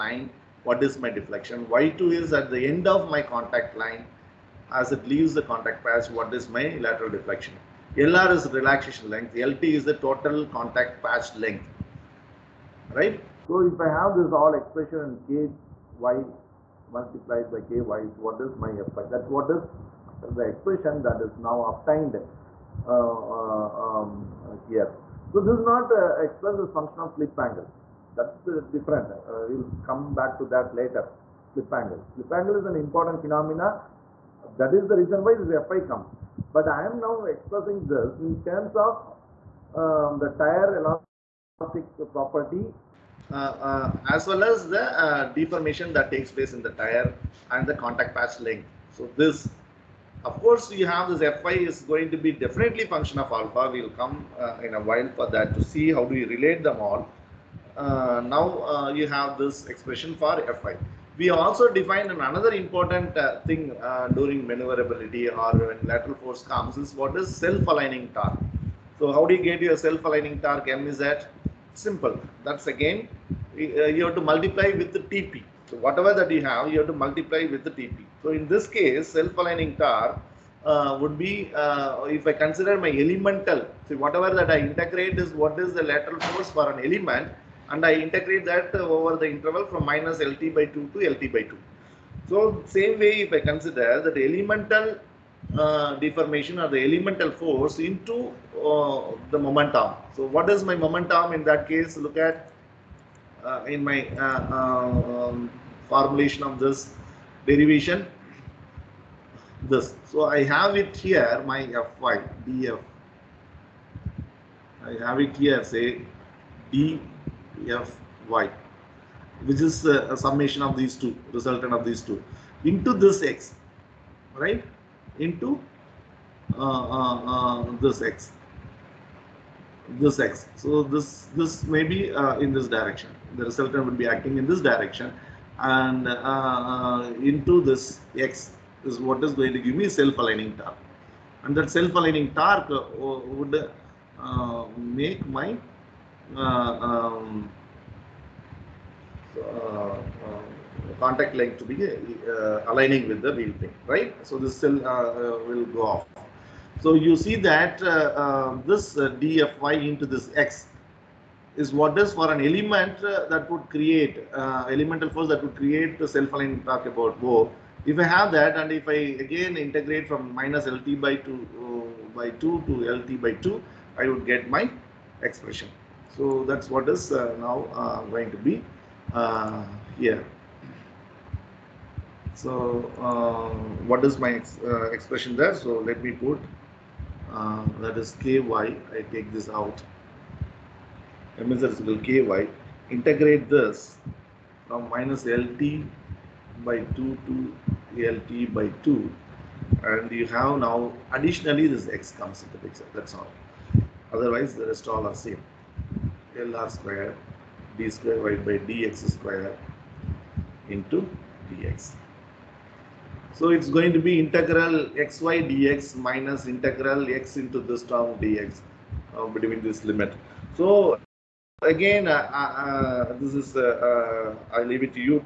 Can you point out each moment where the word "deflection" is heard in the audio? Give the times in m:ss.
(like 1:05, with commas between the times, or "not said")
0:01, 0:07.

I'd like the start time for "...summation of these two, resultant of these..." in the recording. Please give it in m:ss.
2:00.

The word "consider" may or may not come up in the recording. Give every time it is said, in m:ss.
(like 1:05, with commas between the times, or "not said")
1:22, 1:33.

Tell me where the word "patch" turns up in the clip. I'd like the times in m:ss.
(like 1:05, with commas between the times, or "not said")
0:05, 0:11, 0:48.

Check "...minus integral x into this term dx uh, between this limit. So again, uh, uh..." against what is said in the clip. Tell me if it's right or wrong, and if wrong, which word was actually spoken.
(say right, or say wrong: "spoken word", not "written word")
right.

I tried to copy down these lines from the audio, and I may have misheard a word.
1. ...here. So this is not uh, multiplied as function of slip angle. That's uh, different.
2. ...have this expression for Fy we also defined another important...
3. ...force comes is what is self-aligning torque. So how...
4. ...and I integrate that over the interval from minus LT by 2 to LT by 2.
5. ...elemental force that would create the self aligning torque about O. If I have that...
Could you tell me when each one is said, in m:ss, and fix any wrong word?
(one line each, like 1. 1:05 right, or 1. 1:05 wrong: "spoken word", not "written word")
1. 0:24 wrong: "expressed", not "multiplied"
2. 0:59 right
3. 1:06 right
4. 1:27 right
5. 2:44 right.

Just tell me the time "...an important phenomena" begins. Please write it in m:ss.
0:32.